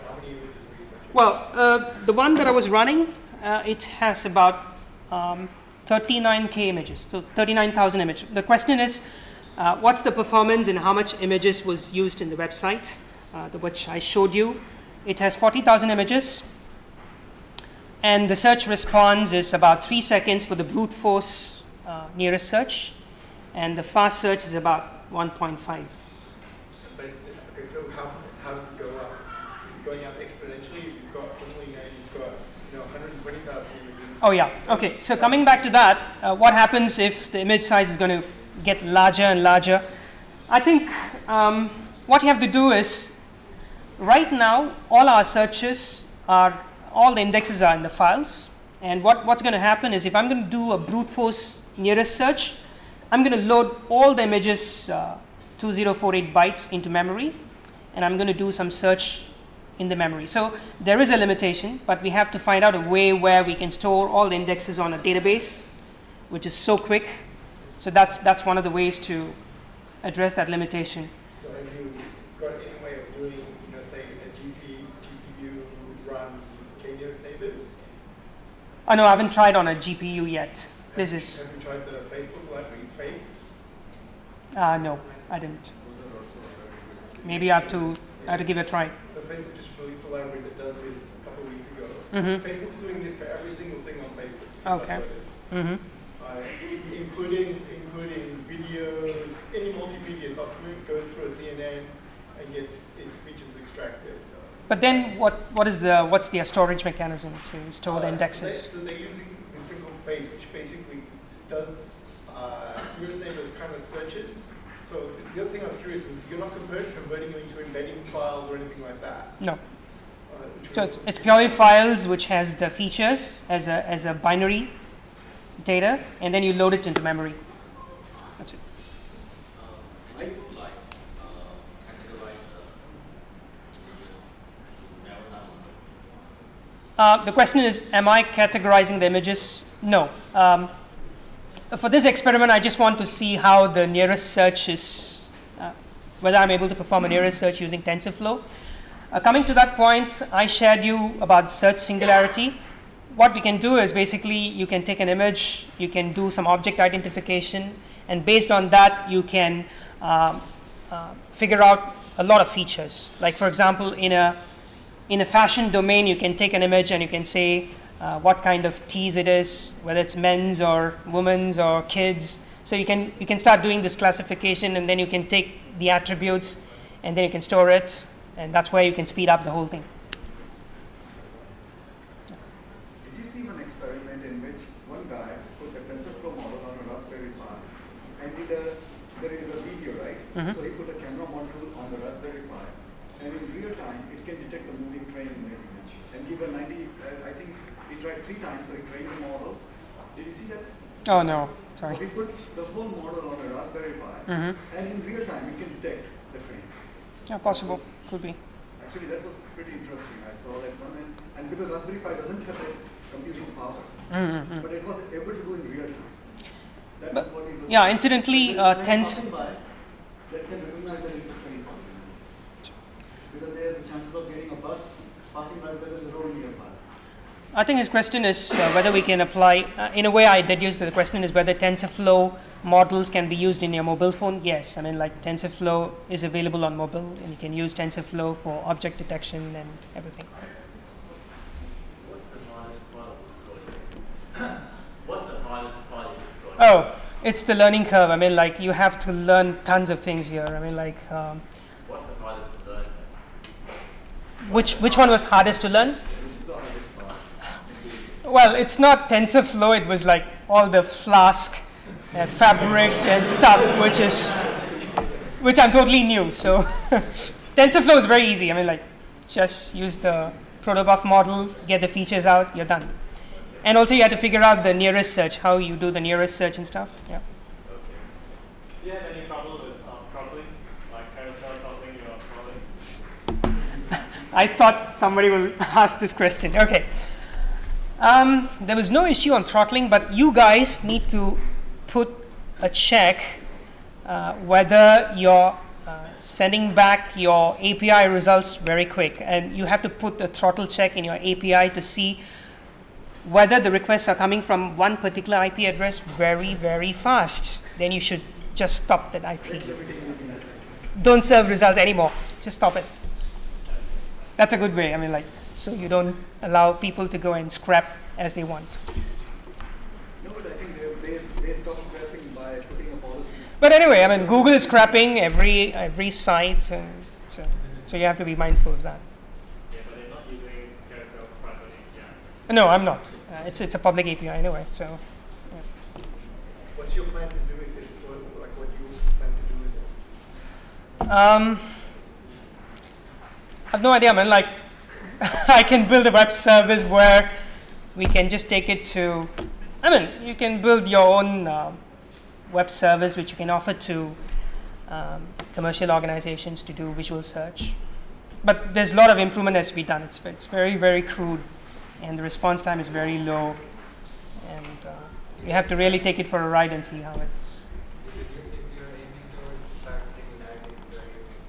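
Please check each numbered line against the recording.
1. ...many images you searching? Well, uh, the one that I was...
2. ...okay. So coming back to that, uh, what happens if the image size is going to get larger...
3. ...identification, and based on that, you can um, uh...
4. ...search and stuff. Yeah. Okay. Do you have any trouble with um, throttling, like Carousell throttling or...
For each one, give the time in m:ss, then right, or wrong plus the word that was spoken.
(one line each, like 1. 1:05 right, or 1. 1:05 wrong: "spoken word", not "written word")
1. 0:00 right
2. 0:34 right
3. 2:36 right
4. 4:36 right.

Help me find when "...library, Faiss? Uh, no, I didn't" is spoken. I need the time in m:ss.
1:22.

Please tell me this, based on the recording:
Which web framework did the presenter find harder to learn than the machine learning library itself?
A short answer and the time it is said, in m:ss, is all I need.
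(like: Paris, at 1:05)
Flask, at 4:20.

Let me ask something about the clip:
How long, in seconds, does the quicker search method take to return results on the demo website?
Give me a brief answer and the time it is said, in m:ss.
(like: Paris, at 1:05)
1.5, at 0:25.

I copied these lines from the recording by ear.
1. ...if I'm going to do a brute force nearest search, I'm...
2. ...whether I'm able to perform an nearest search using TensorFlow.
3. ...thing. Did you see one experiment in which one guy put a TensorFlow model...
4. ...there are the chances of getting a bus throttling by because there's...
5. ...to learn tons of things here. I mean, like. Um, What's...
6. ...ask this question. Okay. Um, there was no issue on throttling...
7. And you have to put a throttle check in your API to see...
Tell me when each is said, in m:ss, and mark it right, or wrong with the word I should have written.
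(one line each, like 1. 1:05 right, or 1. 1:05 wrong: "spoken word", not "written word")
1. 0:50 right
2. 2:26 right
3. 2:59 right
4. 3:43 wrong: "passing", not "throttling"
5. 4:09 right
6. 4:45 right
7. 4:59 right.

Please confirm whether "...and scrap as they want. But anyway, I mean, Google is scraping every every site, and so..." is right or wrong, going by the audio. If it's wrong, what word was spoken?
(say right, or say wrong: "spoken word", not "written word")
right.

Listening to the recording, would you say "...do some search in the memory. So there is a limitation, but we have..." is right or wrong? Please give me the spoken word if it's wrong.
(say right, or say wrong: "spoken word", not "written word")
right.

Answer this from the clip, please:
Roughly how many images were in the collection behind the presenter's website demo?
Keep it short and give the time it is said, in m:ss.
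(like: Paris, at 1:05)
40,000, at 0:15.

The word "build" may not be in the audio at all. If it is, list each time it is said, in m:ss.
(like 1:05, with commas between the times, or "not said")
5:45, 5:50.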